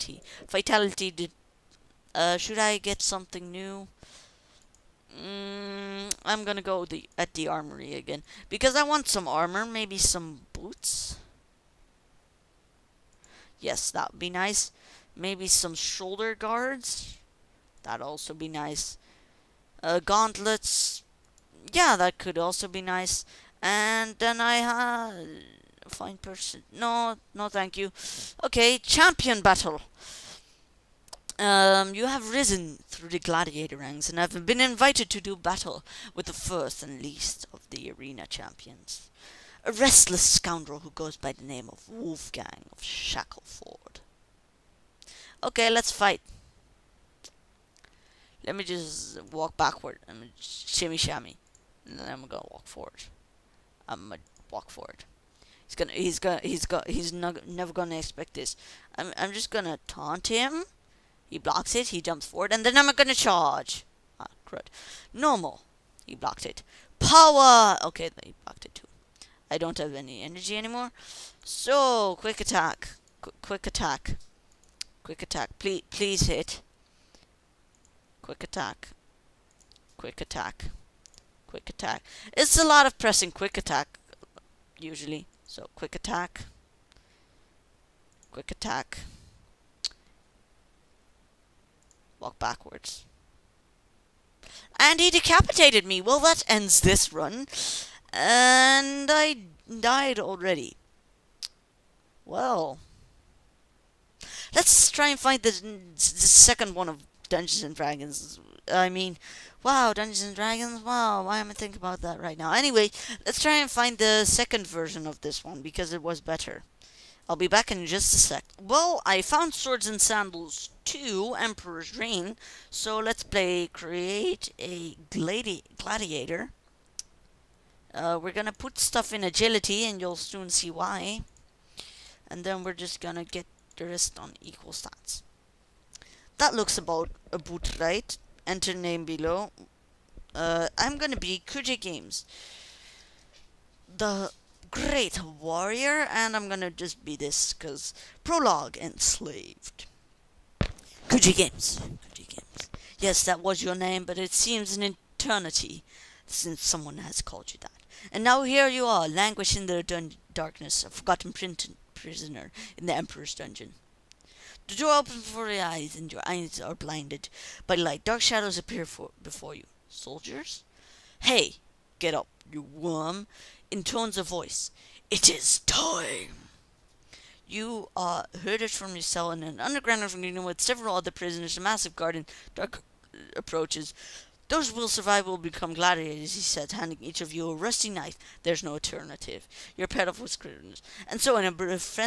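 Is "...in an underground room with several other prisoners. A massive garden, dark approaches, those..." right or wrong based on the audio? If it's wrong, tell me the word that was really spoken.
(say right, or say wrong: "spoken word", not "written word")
right.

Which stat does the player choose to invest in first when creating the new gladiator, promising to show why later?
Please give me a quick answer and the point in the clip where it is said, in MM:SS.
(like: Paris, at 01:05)
Agility, at 02:09.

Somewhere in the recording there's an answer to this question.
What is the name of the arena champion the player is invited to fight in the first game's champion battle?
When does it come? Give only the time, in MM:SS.
00:41.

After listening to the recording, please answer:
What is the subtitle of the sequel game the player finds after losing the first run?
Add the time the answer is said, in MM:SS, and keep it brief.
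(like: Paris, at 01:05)
Emperor's Reign, at 02:01.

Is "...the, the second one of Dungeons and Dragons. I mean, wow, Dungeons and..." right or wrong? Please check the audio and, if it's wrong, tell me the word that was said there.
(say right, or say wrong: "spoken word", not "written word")
right.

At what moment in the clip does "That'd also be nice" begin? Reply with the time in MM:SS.
00:17.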